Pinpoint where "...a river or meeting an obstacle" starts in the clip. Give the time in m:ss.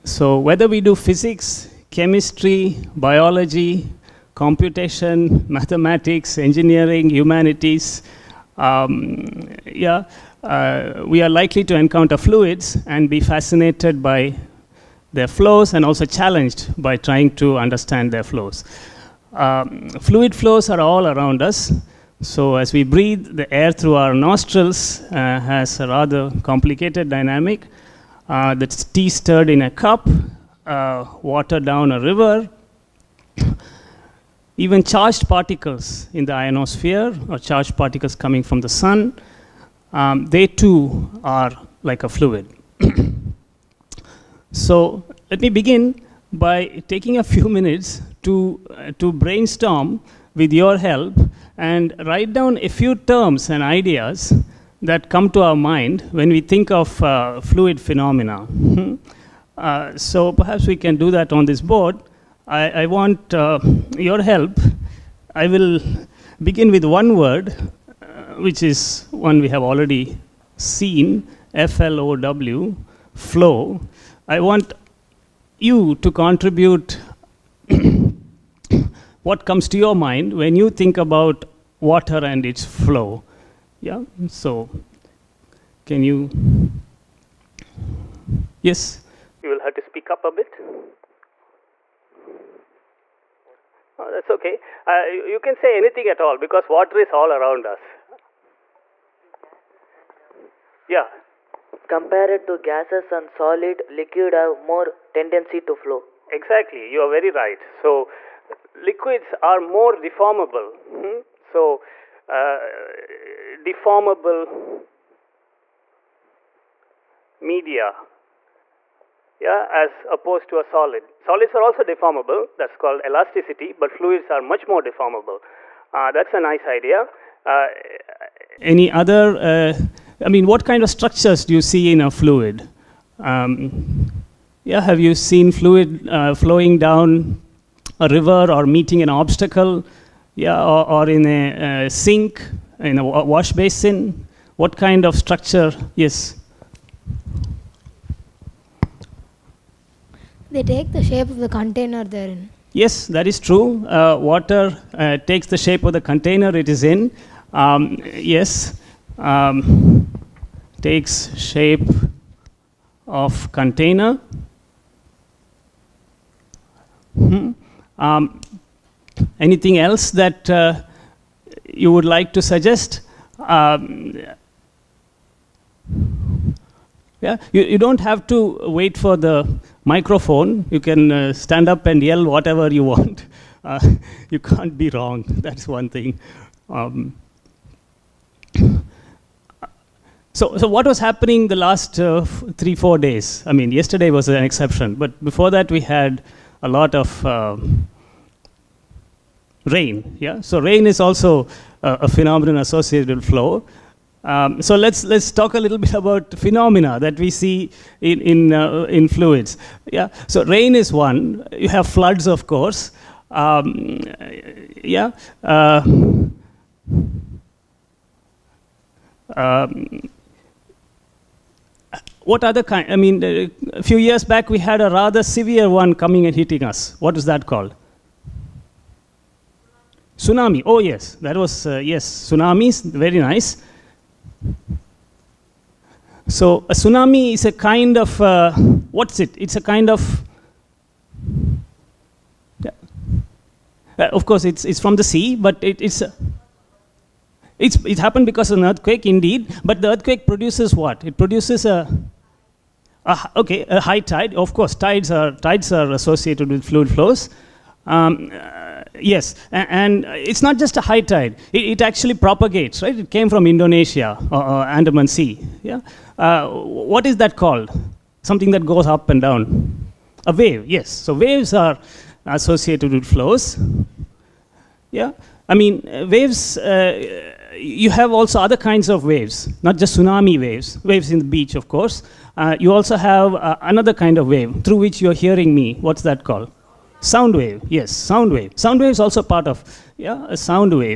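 2:17.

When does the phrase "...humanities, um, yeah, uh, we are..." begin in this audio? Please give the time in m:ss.
0:07.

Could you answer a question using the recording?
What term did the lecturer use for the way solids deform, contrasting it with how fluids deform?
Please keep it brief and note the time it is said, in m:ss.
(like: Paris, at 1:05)
Elasticity, at 2:03.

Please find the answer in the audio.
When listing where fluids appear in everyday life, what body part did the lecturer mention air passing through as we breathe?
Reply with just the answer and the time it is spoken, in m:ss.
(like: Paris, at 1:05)
Nostrils, at 0:24.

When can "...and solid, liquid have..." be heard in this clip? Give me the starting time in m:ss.
1:43.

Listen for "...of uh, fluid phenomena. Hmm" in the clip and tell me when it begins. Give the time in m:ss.
0:56.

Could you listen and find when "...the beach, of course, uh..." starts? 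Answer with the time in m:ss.
4:41.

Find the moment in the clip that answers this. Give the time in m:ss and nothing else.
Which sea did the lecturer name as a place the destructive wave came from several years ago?
4:24.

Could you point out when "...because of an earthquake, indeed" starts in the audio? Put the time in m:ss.
4:08.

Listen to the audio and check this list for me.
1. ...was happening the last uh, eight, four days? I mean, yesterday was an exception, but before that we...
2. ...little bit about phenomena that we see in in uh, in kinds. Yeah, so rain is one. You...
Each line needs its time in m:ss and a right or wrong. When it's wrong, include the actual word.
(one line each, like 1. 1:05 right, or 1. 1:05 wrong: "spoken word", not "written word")
1. 3:10 wrong: "three", not "eight"
2. 3:25 wrong: "fluids", not "kinds".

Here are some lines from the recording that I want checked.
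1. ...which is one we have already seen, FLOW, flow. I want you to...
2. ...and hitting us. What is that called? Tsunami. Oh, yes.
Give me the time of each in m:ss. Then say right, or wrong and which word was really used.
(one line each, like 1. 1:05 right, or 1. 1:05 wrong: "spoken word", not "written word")
1. 1:08 right
2. 3:46 right.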